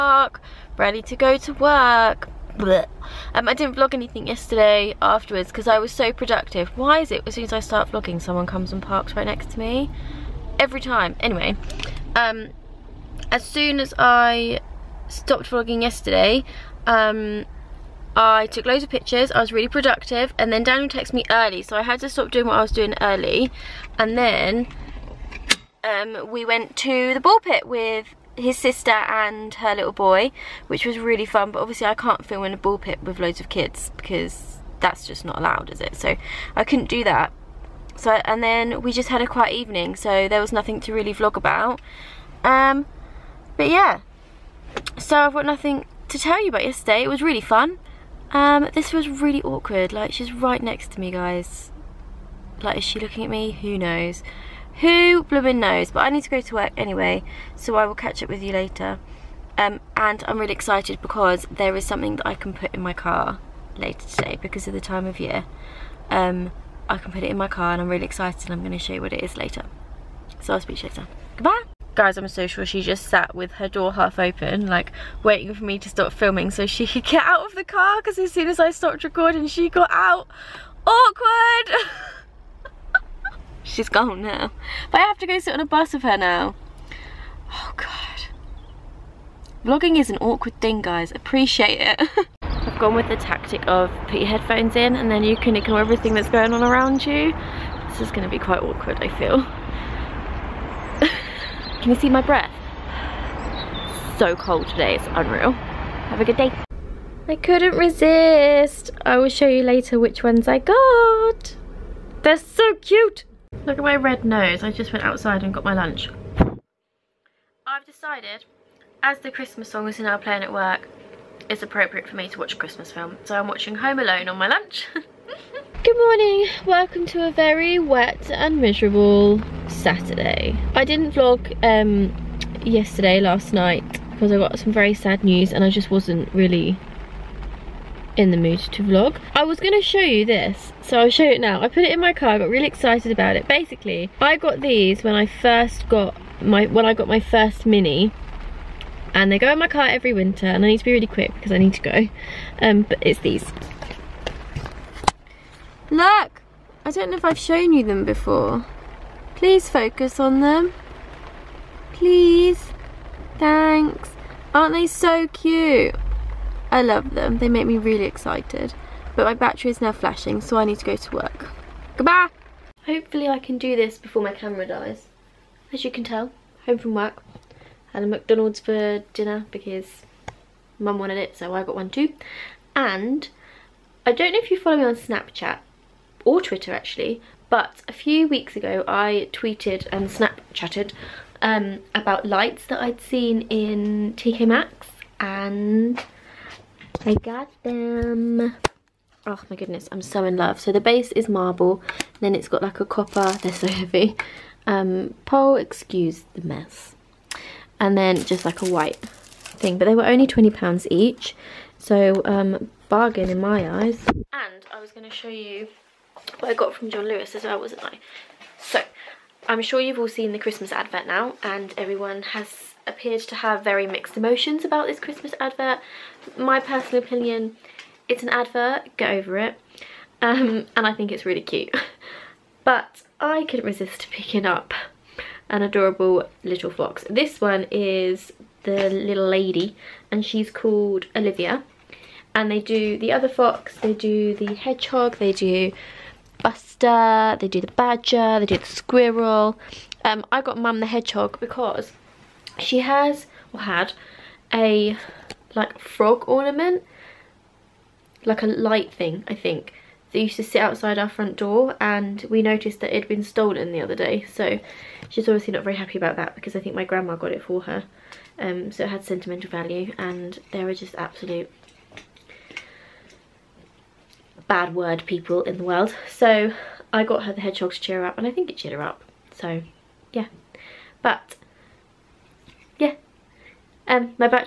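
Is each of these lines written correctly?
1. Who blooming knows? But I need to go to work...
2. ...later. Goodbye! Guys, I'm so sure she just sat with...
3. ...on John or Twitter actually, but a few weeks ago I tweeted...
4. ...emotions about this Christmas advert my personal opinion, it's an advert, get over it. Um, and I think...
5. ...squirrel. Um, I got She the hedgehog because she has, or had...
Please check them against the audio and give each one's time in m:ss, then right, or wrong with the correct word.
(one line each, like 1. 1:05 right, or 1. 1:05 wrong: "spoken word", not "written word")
1. 0:54 right
2. 1:10 right
3. 3:04 wrong: "Snapchat", not "John"
4. 3:44 right
5. 4:08 wrong: "Mum", not "She".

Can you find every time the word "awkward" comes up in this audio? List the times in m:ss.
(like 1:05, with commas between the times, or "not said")
0:49, 1:20, 1:30, 1:38.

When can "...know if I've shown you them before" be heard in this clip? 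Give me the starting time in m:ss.
2:37.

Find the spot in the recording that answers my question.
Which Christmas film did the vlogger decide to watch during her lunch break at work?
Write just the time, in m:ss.
2:03.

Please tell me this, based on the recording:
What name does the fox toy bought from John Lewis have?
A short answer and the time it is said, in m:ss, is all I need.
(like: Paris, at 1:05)
Olivia, at 4:01.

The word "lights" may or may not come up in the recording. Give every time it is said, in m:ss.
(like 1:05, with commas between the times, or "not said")
3:12, 4:18.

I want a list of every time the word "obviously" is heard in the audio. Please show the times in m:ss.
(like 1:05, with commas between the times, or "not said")
0:31, 4:25.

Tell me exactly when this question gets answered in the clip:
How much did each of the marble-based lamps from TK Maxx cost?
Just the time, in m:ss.
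3:30.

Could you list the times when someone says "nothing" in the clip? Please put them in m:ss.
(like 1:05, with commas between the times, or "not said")
0:40, 0:45.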